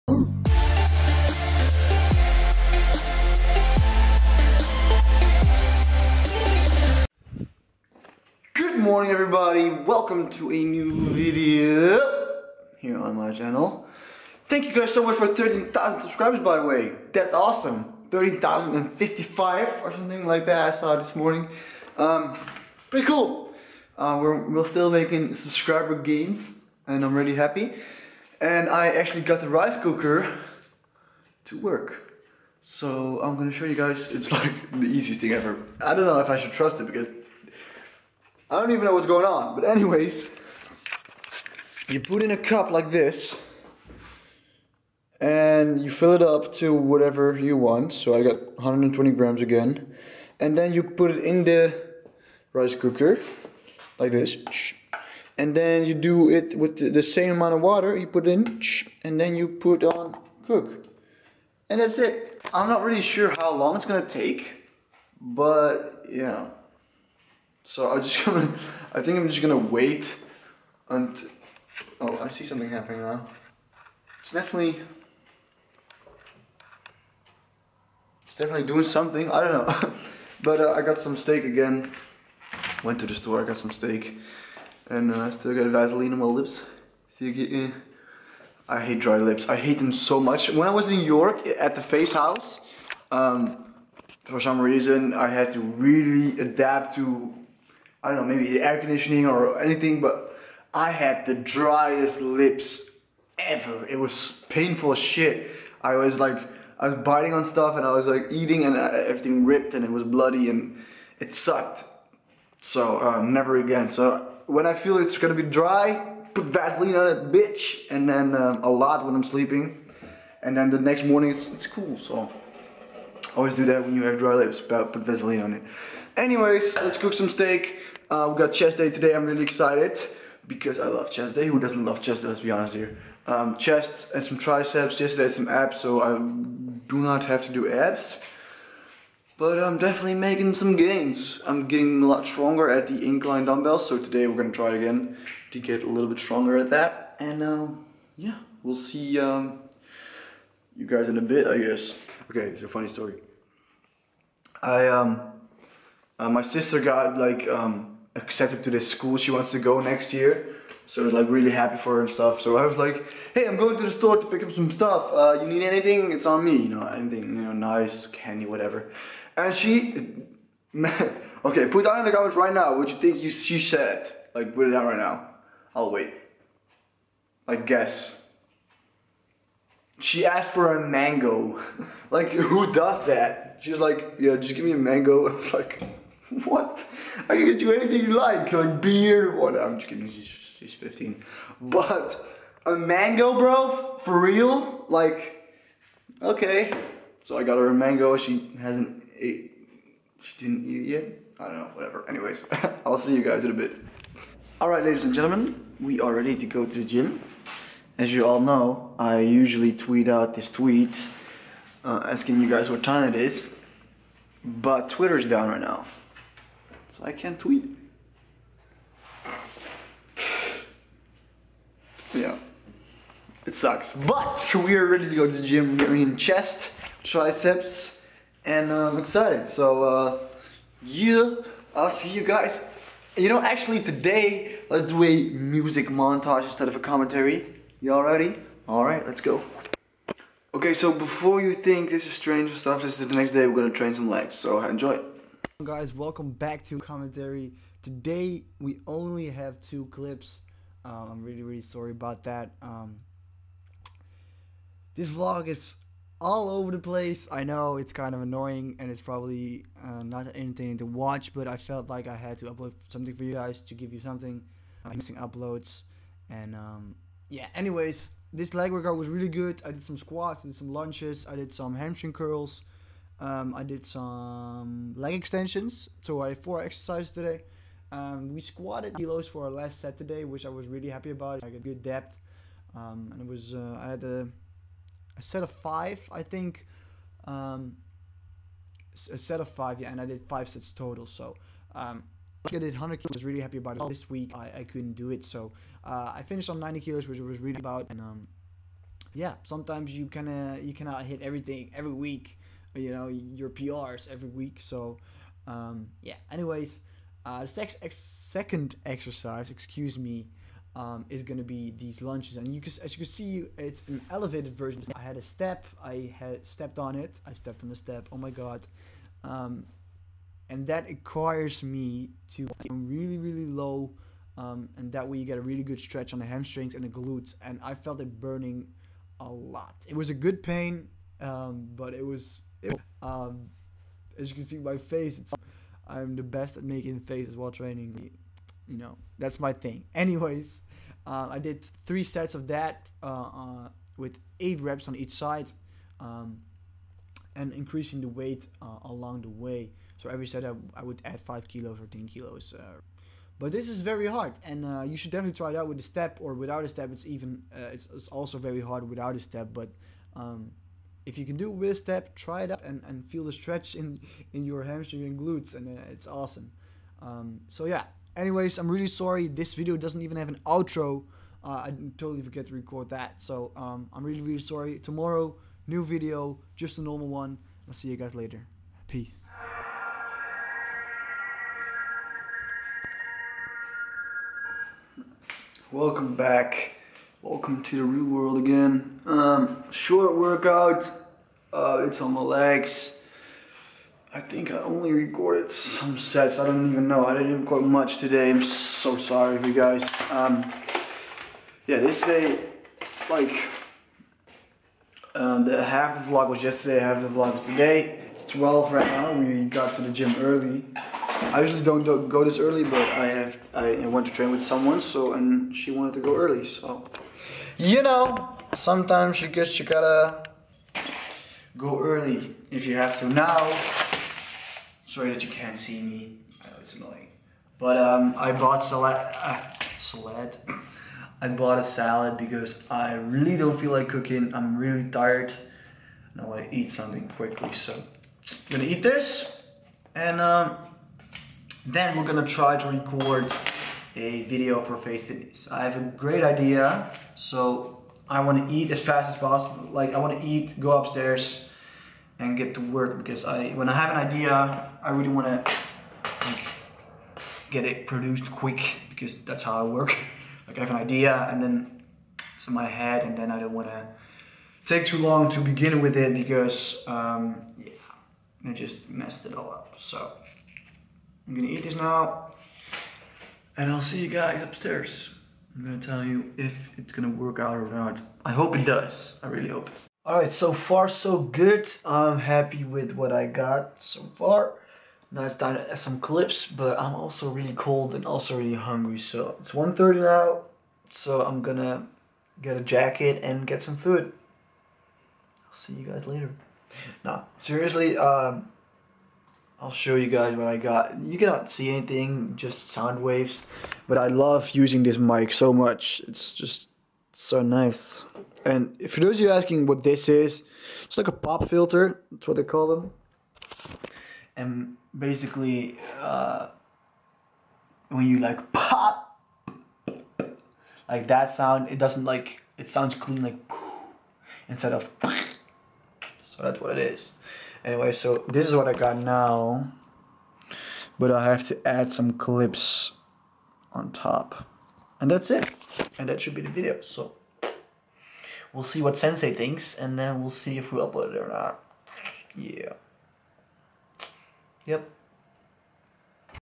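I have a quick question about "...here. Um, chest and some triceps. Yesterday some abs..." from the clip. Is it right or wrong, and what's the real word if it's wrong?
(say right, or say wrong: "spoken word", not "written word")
right.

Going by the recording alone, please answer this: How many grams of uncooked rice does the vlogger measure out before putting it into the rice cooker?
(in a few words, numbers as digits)
120 grams.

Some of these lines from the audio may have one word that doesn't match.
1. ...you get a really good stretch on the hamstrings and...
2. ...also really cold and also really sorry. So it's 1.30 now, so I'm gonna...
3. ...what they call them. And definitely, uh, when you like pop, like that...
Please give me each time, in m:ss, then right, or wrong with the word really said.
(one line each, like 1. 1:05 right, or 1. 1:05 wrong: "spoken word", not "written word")
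1. 5:25 right
2. 8:06 wrong: "hungry", not "sorry"
3. 8:32 wrong: "basically", not "definitely".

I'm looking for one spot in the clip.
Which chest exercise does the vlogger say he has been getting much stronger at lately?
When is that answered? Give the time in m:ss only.
2:23.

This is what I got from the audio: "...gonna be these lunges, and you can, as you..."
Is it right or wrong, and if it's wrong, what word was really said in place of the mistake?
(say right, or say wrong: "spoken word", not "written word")
right.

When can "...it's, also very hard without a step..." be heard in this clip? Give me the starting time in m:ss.
5:57.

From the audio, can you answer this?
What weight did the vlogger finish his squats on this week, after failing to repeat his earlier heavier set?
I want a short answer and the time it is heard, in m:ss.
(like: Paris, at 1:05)
90 kilos, at 4:56.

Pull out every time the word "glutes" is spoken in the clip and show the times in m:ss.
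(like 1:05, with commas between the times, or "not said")
5:26, 6:05.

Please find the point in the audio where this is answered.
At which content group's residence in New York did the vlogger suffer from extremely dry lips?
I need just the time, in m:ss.
1:31.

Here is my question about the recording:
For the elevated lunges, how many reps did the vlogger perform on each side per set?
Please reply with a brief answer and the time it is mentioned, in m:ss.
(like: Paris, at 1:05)
8, at 5:44.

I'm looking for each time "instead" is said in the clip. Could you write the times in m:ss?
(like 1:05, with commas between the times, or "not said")
3:56, 8:44.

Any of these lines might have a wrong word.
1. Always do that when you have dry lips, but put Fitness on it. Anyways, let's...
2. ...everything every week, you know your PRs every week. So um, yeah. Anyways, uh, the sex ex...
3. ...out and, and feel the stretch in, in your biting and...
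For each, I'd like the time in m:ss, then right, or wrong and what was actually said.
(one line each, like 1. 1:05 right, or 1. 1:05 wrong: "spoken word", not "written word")
1. 2:03 wrong: "Vaseline", not "Fitness"
2. 5:01 right
3. 6:02 wrong: "hamstring", not "biting".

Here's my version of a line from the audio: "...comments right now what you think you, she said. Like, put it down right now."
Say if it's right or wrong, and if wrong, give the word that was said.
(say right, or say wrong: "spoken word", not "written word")
right.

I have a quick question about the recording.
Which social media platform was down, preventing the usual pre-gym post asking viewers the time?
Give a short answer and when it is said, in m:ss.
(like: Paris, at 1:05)
Twitter, at 3:34.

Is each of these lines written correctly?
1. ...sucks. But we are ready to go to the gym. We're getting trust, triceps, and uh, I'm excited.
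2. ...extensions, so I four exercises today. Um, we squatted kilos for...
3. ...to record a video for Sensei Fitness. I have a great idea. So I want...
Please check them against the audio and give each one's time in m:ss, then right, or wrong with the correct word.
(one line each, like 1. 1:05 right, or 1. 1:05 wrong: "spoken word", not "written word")
1. 3:43 wrong: "chest", not "trust"
2. 4:35 right
3. 7:22 wrong: "FaZe", not "Sensei".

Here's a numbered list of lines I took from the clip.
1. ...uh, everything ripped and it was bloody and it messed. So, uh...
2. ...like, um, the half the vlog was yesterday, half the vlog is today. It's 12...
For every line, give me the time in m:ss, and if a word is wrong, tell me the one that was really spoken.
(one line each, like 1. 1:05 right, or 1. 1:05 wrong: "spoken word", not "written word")
1. 1:48 wrong: "sucked", not "messed"
2. 6:43 right.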